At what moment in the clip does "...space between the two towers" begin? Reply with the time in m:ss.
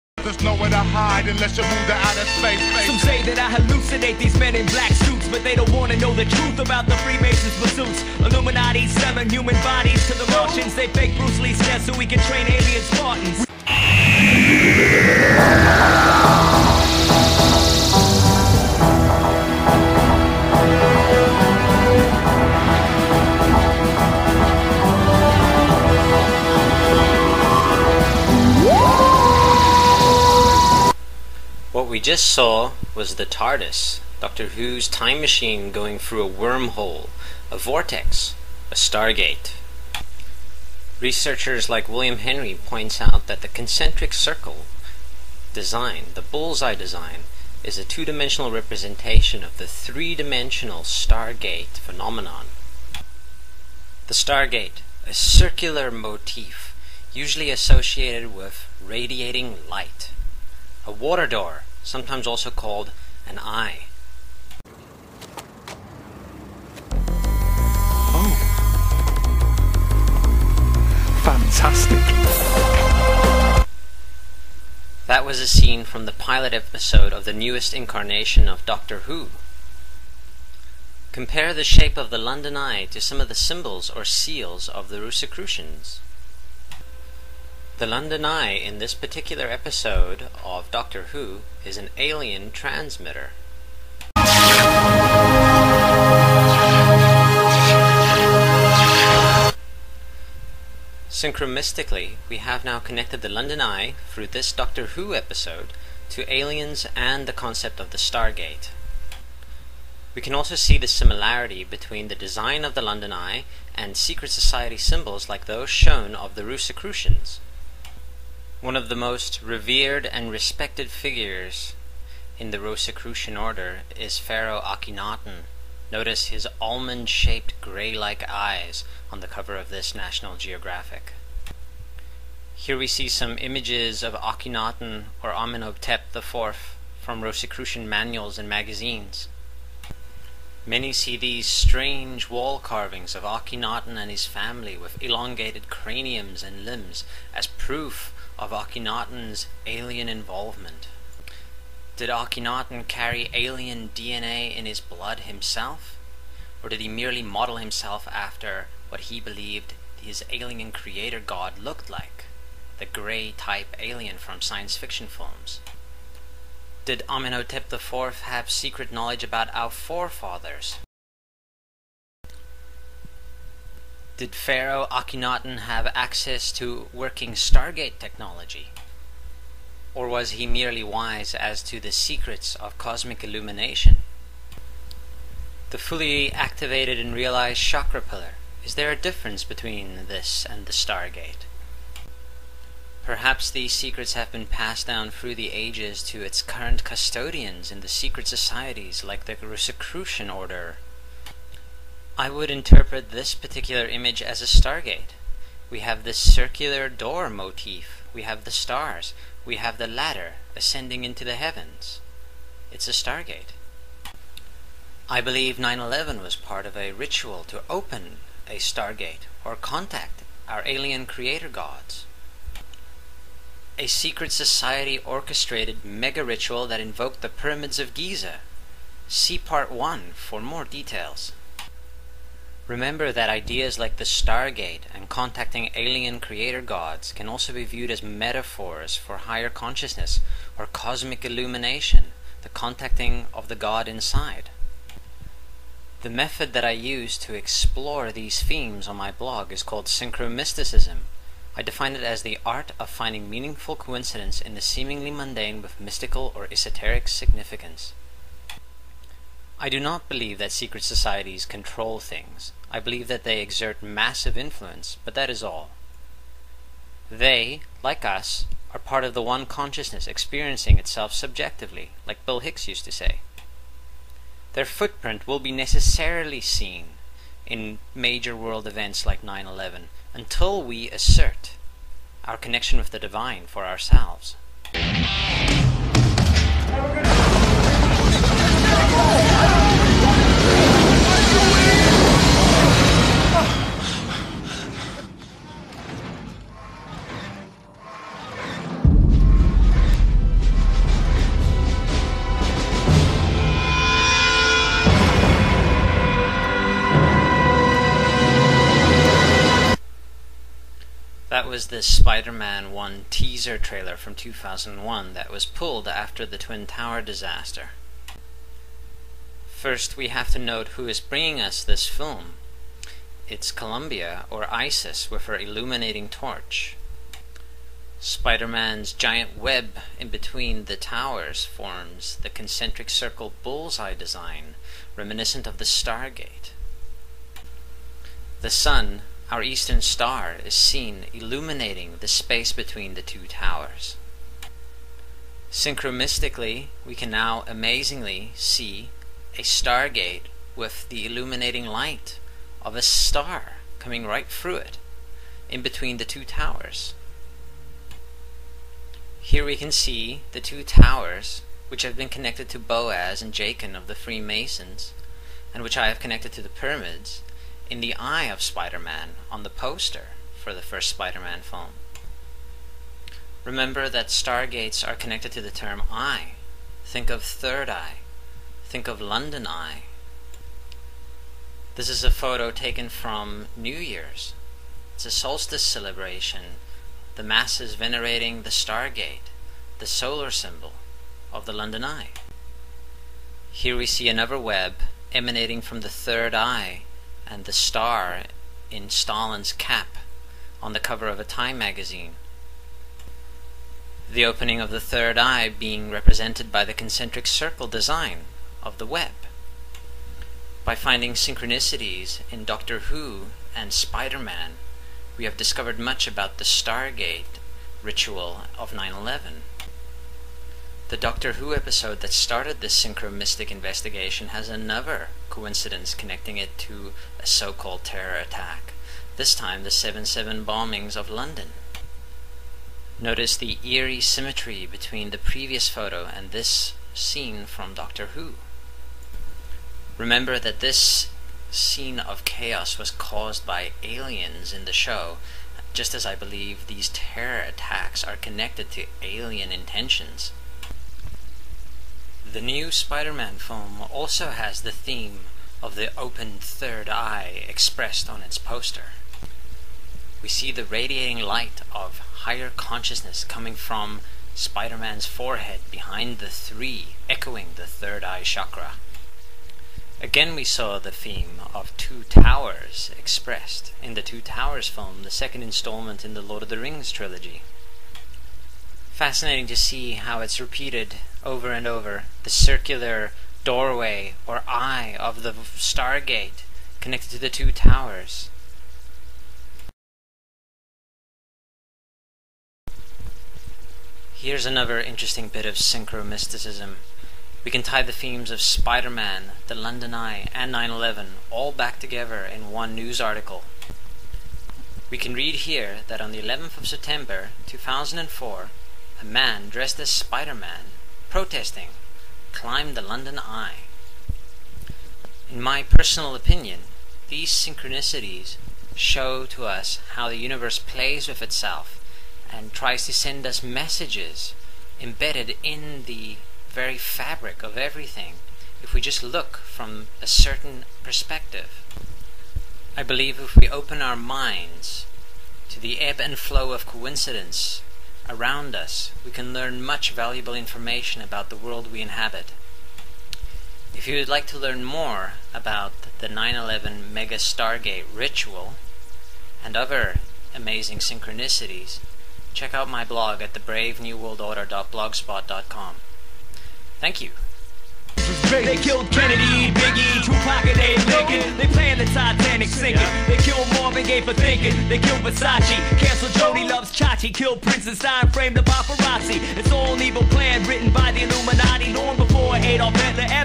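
5:42.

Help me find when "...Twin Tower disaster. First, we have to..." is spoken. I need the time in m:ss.
5:16.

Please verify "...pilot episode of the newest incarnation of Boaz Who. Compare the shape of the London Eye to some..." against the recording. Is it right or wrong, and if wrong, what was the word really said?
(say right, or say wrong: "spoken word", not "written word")
wrong: "Doctor", not "Boaz".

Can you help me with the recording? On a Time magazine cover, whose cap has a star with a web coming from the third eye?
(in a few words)
Stalin.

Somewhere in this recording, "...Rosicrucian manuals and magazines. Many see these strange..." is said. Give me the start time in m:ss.
2:17.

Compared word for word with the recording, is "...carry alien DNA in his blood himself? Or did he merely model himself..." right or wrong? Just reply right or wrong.
right.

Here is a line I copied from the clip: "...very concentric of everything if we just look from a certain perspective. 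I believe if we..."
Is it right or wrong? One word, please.
wrong.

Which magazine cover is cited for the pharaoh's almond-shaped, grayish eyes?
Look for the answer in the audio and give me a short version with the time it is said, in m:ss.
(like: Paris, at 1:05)
National Geographic, at 2:09.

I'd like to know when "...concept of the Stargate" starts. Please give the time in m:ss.
1:47.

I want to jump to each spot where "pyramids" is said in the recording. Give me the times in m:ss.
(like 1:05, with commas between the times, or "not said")
3:47, 6:06.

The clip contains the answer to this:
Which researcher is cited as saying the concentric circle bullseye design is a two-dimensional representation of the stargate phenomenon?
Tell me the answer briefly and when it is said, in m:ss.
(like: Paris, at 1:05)
William Henry, at 0:41.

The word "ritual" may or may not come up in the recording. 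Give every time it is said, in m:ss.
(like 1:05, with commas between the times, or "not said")
3:36, 3:46, 6:57, 9:07.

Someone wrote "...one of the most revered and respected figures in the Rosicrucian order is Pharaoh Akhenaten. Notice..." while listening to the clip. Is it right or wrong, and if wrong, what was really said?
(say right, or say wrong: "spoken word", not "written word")
right.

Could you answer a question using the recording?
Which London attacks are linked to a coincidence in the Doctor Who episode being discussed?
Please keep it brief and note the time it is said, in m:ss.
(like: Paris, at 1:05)
7-7 bombings, at 7:09.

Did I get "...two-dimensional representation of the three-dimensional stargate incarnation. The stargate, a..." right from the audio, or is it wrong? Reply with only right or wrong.
wrong.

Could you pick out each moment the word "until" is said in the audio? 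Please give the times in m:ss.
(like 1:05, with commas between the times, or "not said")
4:40.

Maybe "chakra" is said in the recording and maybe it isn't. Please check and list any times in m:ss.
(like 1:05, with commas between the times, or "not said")
3:07, 7:48.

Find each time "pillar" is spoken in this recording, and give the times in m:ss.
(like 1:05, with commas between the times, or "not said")
3:07.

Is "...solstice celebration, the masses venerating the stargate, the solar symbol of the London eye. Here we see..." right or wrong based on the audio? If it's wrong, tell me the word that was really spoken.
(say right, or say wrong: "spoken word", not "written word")
right.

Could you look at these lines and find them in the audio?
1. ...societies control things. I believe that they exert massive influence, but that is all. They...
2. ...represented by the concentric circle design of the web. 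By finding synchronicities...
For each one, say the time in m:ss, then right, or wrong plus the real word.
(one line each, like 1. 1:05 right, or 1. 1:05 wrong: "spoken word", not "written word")
1. 4:20 right
2. 6:45 right.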